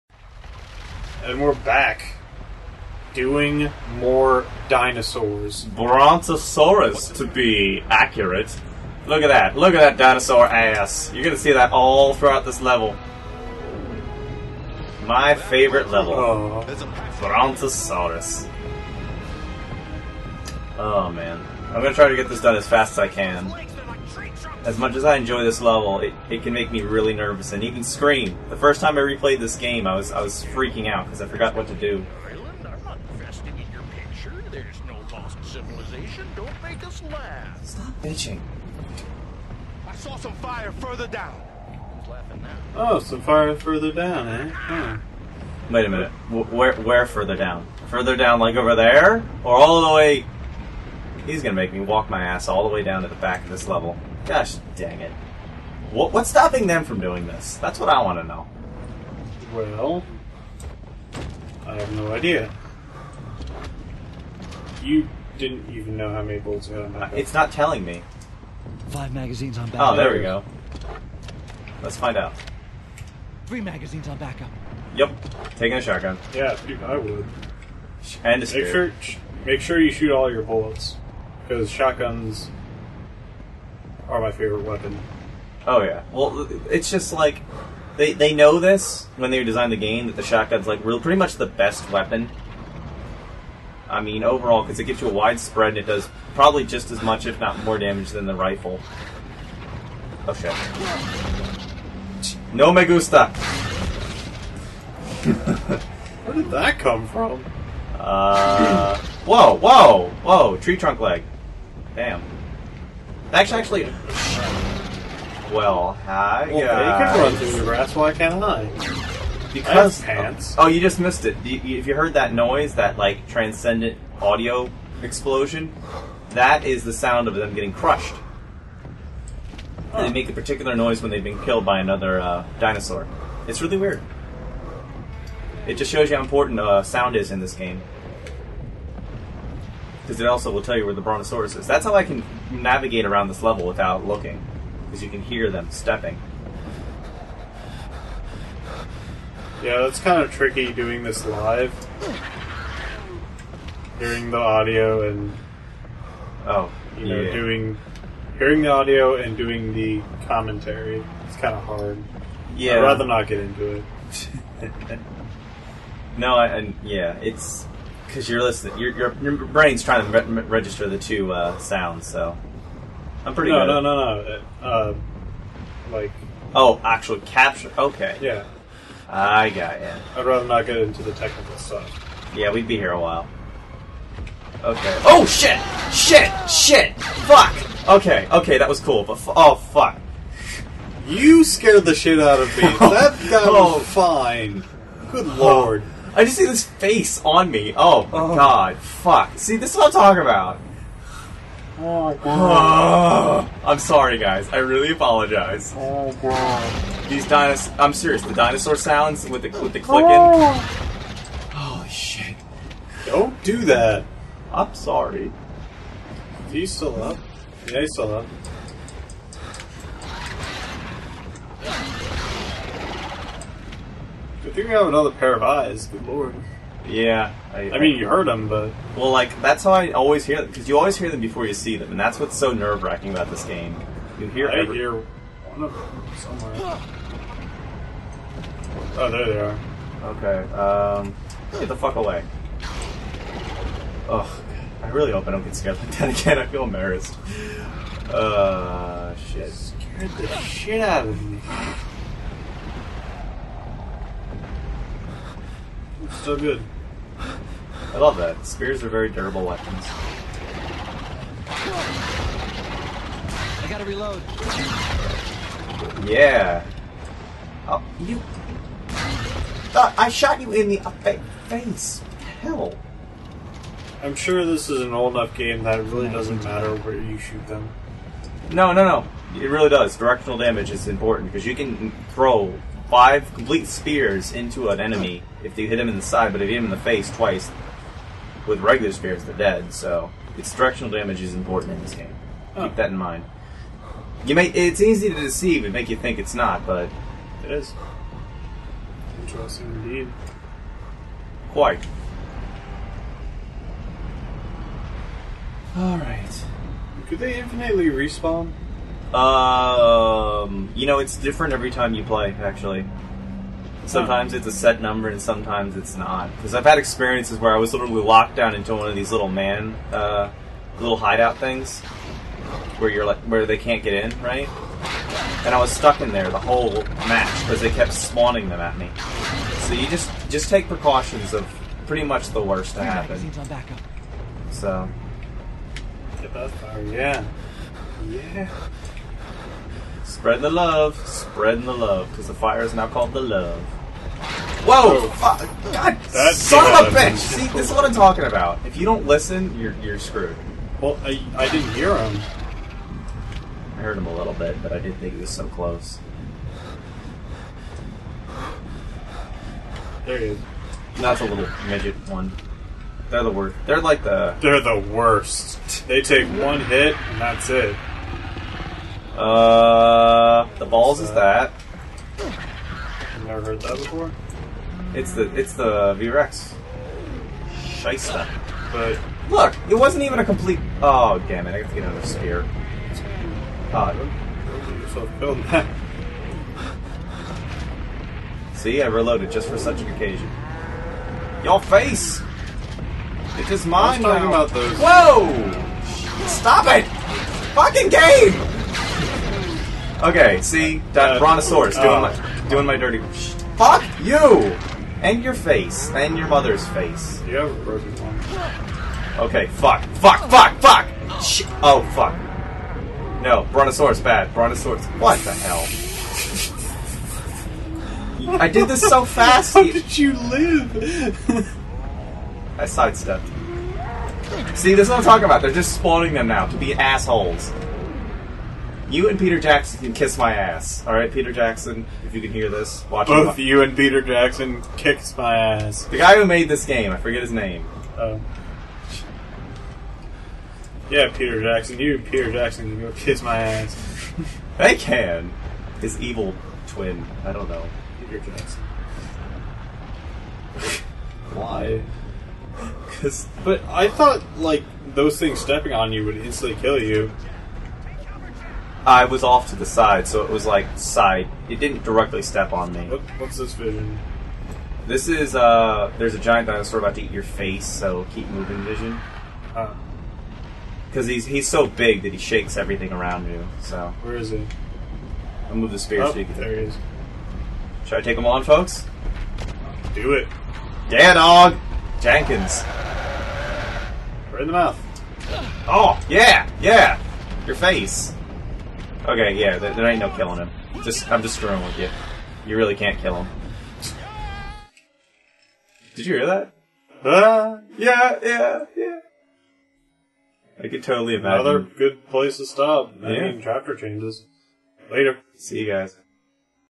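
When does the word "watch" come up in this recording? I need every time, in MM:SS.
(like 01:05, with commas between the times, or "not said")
07:12.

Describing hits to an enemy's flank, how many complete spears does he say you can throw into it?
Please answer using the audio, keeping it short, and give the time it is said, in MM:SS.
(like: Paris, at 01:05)
5, at 04:42.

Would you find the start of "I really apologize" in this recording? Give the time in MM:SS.
03:24.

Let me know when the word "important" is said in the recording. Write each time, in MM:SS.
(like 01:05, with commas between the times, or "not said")
02:16, 04:40, 04:51.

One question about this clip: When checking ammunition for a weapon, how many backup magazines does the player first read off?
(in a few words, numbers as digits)
5.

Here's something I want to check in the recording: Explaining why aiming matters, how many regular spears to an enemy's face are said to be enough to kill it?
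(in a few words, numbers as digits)
2.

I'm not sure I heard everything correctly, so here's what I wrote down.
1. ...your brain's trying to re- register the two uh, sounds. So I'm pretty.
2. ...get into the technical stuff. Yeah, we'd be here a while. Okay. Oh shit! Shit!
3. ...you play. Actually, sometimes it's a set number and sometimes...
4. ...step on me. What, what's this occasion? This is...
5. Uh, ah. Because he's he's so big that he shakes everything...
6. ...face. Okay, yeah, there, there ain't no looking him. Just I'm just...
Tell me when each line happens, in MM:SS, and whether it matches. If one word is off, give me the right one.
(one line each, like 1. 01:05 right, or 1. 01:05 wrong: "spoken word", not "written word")
1. 02:49 right
2. 03:00 right
3. 05:11 right
4. 07:42 wrong: "vision", not "occasion"
5. 07:48 right
6. 08:07 wrong: "killing", not "looking".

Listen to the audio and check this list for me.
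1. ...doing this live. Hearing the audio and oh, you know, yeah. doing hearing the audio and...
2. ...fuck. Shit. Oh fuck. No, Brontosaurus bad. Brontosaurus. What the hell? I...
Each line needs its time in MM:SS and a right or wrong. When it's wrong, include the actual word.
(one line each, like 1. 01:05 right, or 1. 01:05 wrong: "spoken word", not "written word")
1. 02:30 right
2. 06:50 right.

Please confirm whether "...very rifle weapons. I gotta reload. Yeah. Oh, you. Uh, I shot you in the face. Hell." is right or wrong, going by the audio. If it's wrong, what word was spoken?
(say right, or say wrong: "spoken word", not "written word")
wrong: "durable", not "rifle".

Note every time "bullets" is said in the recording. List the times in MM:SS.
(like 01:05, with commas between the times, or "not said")
01:06, 01:20.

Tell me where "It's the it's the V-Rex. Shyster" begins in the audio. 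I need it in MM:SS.
06:14.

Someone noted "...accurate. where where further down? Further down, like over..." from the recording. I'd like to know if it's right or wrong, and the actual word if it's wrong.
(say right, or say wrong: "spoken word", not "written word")
wrong: "minute", not "accurate".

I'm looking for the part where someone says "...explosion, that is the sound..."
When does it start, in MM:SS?
02:05.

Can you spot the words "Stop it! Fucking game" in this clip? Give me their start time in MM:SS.
06:36.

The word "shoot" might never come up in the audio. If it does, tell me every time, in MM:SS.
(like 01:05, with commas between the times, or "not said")
01:19, 04:37.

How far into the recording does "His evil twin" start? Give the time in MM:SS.
07:25.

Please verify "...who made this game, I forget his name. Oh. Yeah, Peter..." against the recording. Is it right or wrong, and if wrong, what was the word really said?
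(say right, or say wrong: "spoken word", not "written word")
right.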